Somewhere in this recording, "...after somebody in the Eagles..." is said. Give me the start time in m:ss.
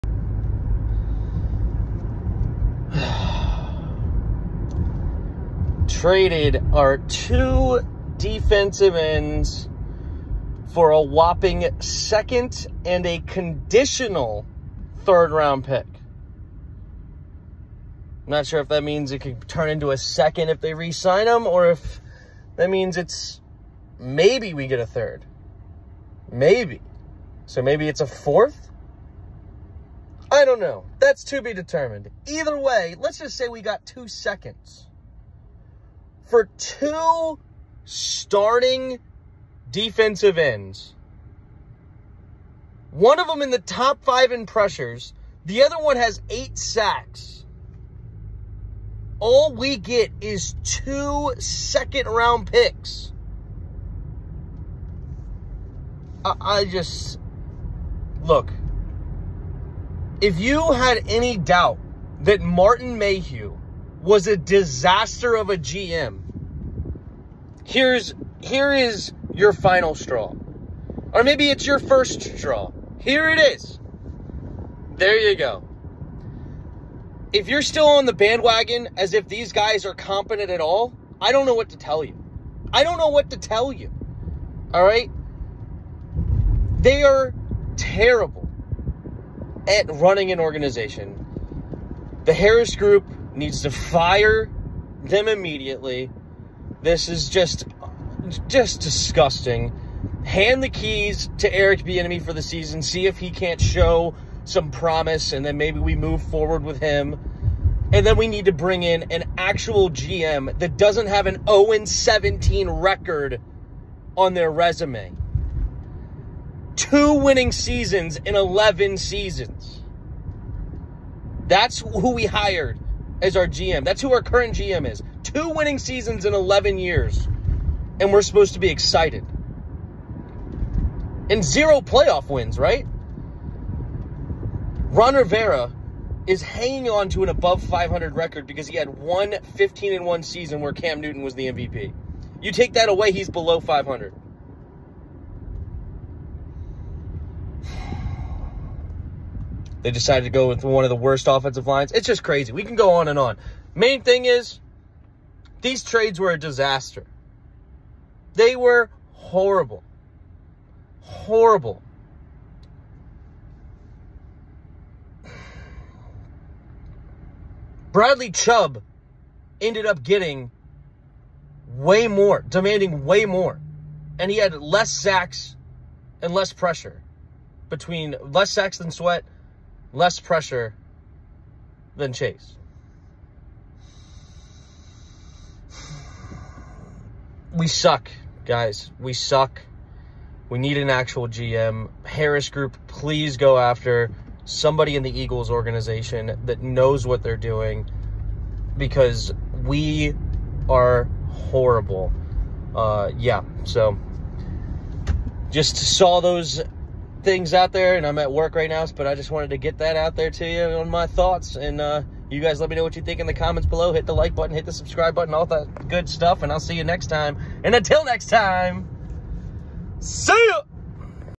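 3:13.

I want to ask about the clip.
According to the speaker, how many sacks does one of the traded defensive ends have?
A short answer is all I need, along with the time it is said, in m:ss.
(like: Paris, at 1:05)
8, at 0:46.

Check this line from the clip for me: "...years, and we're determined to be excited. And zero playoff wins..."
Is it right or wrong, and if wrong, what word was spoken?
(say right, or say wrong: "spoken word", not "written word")
wrong: "supposed", not "determined".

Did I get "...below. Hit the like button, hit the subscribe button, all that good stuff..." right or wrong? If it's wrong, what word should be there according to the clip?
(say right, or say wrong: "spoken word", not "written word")
right.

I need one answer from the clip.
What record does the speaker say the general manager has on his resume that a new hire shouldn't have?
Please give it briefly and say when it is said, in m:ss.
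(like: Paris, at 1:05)
0-17, at 1:51.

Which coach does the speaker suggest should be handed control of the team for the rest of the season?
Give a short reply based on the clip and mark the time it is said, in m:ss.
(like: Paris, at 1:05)
Eric Bieniemy, at 1:41.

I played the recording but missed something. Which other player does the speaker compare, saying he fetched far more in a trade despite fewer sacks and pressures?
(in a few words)
Bradley Chubb.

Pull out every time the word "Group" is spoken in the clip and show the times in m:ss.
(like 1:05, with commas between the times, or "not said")
1:32, 3:12.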